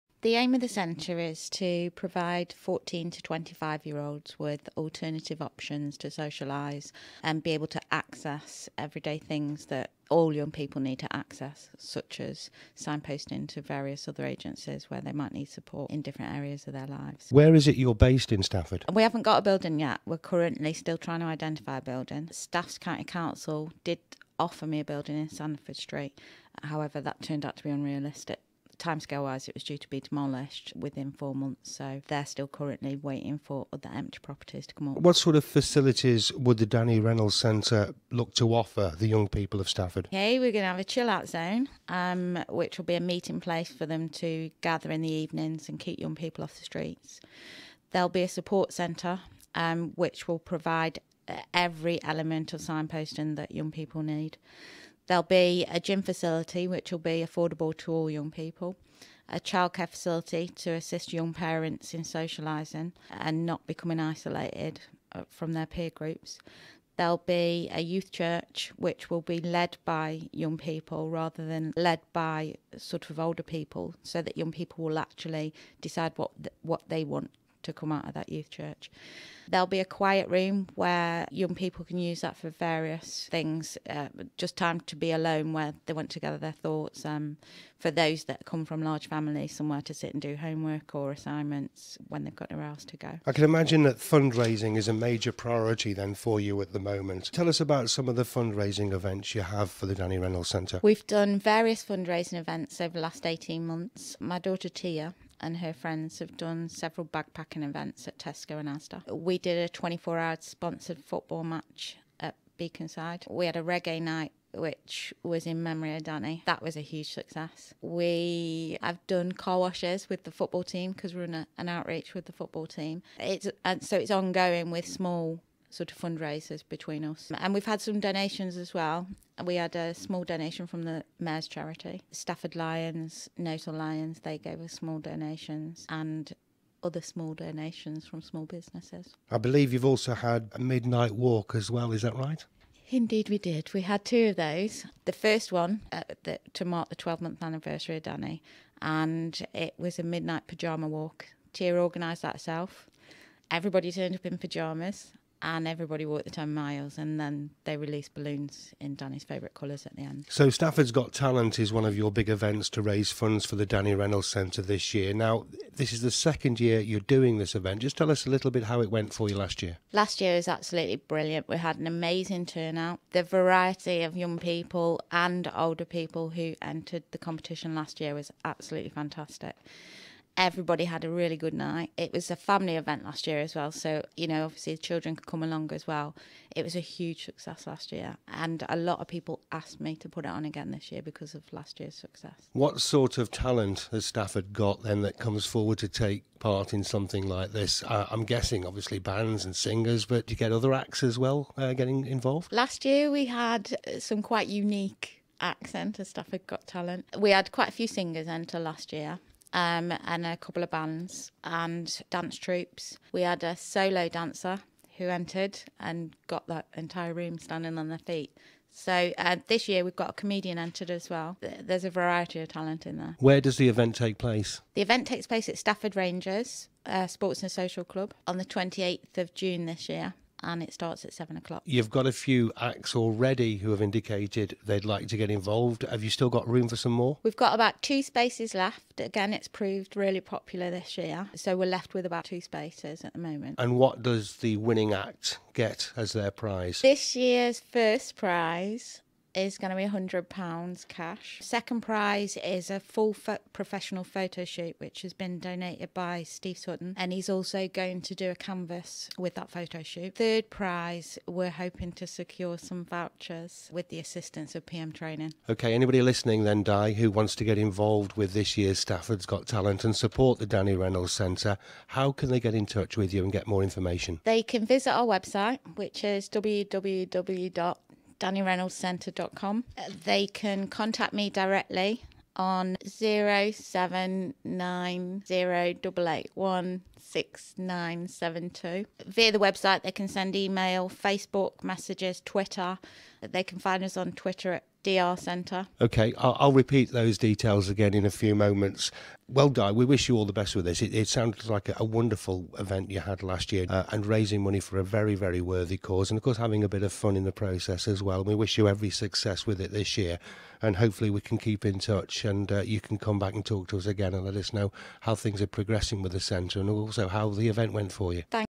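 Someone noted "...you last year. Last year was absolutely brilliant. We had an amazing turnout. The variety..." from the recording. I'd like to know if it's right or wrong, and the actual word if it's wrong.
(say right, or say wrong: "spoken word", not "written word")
right.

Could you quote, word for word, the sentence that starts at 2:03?
It's and so it's ongoing with small sort of fundraisers between us.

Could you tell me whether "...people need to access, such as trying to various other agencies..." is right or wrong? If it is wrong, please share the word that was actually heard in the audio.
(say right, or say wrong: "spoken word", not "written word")
wrong: "signposting", not "trying".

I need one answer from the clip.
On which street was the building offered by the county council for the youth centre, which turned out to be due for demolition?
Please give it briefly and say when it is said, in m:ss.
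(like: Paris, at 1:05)
Sandford Street, at 0:25.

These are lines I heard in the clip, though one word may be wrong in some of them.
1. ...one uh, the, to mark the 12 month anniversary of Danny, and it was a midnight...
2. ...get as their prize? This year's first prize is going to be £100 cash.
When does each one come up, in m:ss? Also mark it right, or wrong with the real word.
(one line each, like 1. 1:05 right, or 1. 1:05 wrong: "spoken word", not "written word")
1. 2:25 right
2. 4:05 right.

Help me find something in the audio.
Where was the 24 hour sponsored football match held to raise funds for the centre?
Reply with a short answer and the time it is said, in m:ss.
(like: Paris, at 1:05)
Beaconside, at 1:52.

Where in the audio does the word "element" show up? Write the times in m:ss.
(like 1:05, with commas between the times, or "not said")
0:52.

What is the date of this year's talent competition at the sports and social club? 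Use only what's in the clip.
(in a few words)
28th of June.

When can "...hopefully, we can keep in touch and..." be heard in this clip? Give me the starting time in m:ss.
5:10.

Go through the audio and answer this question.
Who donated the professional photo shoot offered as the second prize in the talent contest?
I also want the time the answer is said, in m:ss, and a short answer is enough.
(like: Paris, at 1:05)
Steve Sutton, at 4:16.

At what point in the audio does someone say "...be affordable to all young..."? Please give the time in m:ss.
0:56.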